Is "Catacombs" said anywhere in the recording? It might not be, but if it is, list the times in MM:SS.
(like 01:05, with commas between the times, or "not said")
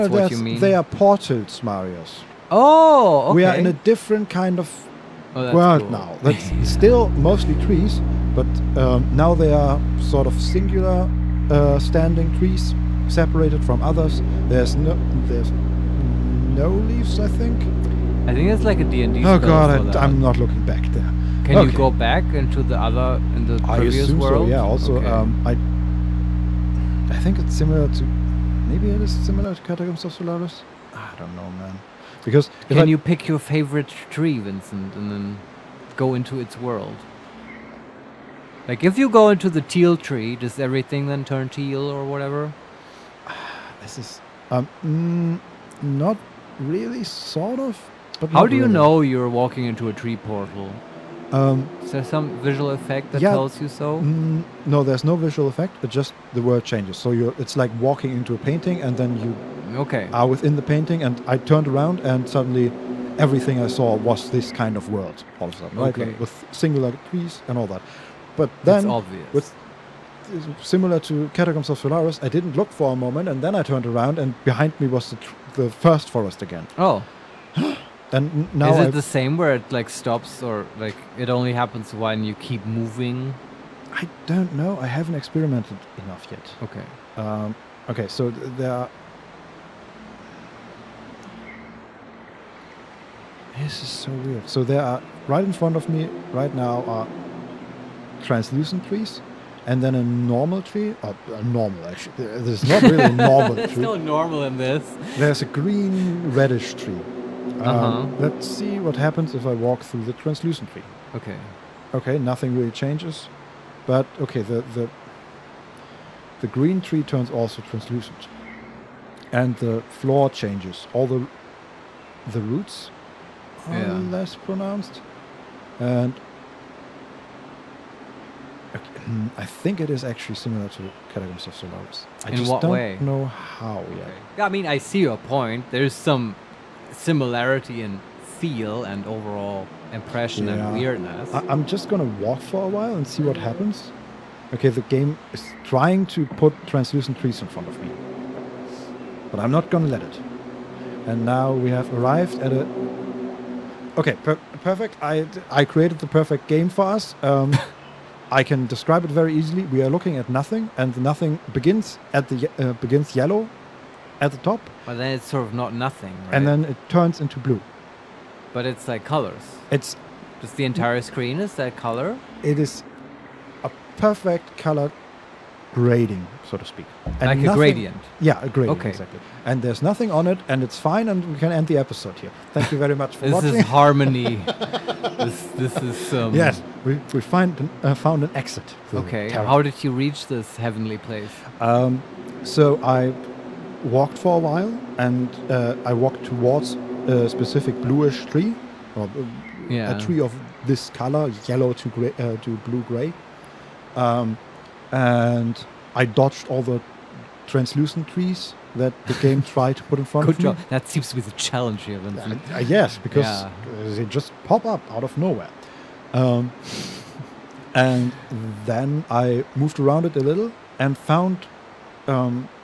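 00:29, 01:11, 02:11.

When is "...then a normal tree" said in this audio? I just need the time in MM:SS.
01:39.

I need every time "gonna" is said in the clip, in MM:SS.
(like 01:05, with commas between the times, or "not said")
02:21, 02:29.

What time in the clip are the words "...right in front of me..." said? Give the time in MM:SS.
01:35.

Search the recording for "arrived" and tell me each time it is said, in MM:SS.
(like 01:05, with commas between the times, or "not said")
02:31.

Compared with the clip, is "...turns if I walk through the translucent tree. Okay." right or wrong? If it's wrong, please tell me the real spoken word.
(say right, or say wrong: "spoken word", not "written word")
wrong: "happens", not "turns".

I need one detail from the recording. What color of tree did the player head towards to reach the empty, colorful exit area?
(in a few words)
bluish.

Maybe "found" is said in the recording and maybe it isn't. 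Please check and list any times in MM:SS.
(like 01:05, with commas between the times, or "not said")
03:07, 03:40.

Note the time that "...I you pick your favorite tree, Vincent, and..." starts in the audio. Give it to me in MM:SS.
00:32.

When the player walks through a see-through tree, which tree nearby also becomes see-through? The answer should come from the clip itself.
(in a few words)
the green tree.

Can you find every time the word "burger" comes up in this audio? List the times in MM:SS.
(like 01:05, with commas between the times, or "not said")
not said.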